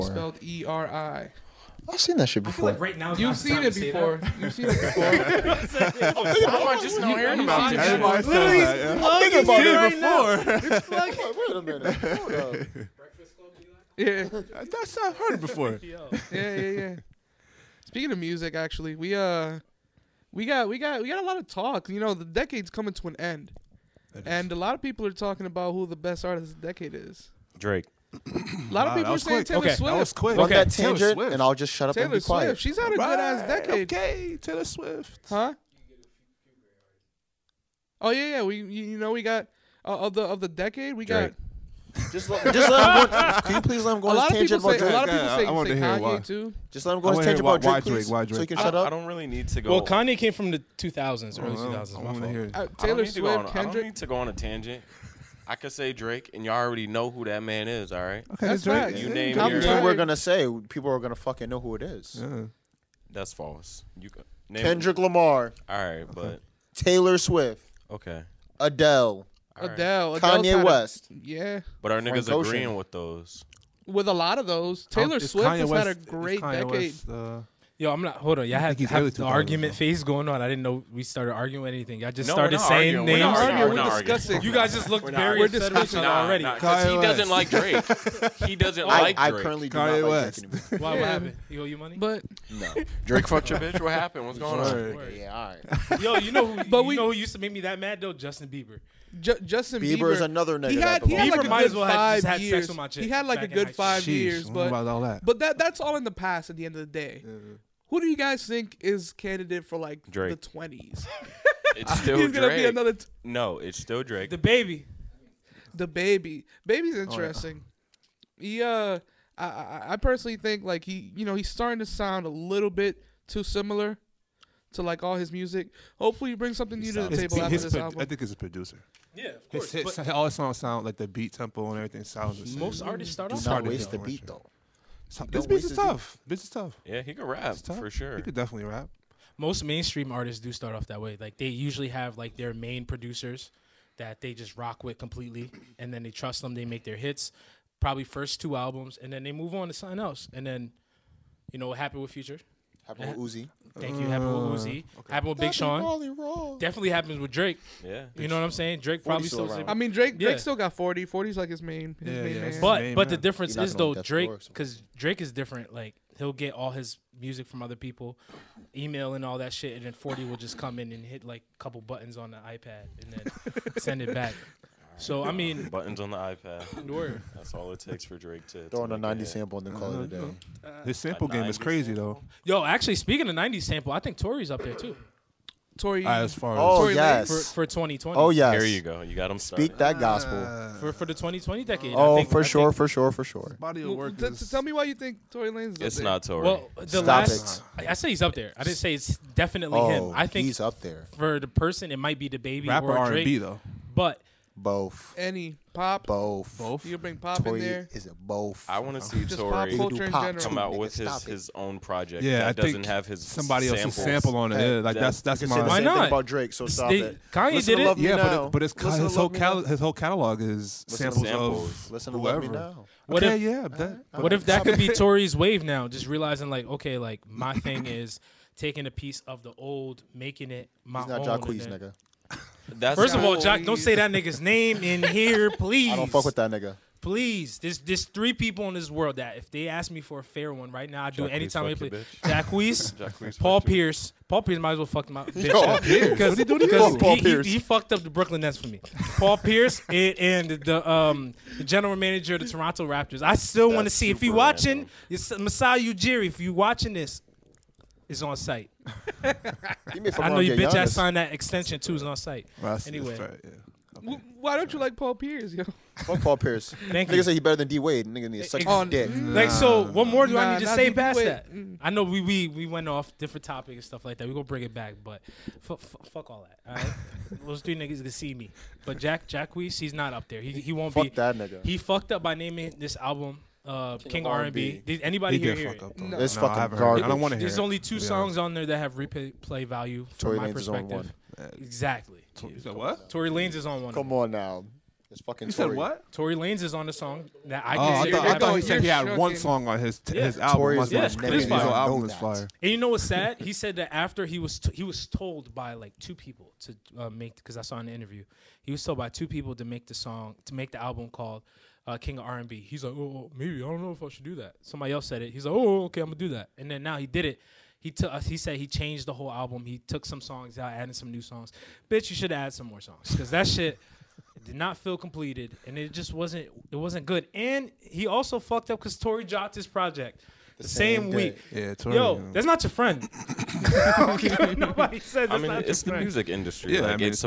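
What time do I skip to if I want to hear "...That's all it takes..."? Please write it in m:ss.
2:57.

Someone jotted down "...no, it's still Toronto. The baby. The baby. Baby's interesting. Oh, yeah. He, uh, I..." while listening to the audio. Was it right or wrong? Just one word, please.
wrong.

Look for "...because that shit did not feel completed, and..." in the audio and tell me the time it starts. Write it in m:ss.
5:23.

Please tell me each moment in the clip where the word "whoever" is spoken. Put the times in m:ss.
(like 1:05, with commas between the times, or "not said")
3:42.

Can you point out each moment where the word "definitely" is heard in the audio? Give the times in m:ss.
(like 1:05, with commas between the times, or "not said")
2:18, 2:36, 3:19.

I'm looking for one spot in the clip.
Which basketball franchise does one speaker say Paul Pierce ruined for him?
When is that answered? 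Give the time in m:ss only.
4:08.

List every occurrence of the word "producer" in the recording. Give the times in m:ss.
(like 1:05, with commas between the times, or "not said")
2:08, 2:22.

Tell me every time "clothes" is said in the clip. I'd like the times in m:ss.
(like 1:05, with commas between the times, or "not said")
not said.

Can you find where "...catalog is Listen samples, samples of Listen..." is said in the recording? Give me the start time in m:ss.
3:39.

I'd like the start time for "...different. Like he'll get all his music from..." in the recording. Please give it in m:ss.
2:45.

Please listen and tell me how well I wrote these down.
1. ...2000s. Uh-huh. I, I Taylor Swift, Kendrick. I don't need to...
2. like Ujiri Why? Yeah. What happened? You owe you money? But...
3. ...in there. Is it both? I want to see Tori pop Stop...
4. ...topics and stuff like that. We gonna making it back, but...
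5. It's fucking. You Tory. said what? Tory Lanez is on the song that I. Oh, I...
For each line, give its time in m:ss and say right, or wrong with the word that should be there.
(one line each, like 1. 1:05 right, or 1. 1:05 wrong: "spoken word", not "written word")
1. 0:51 right
2. 1:30 wrong: "Drake", not "Ujiri"
3. 3:27 wrong: "Tory", not "Stop"
4. 4:33 wrong: "bring", not "making"
5. 4:55 right.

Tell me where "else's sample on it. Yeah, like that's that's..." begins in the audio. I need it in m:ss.
3:33.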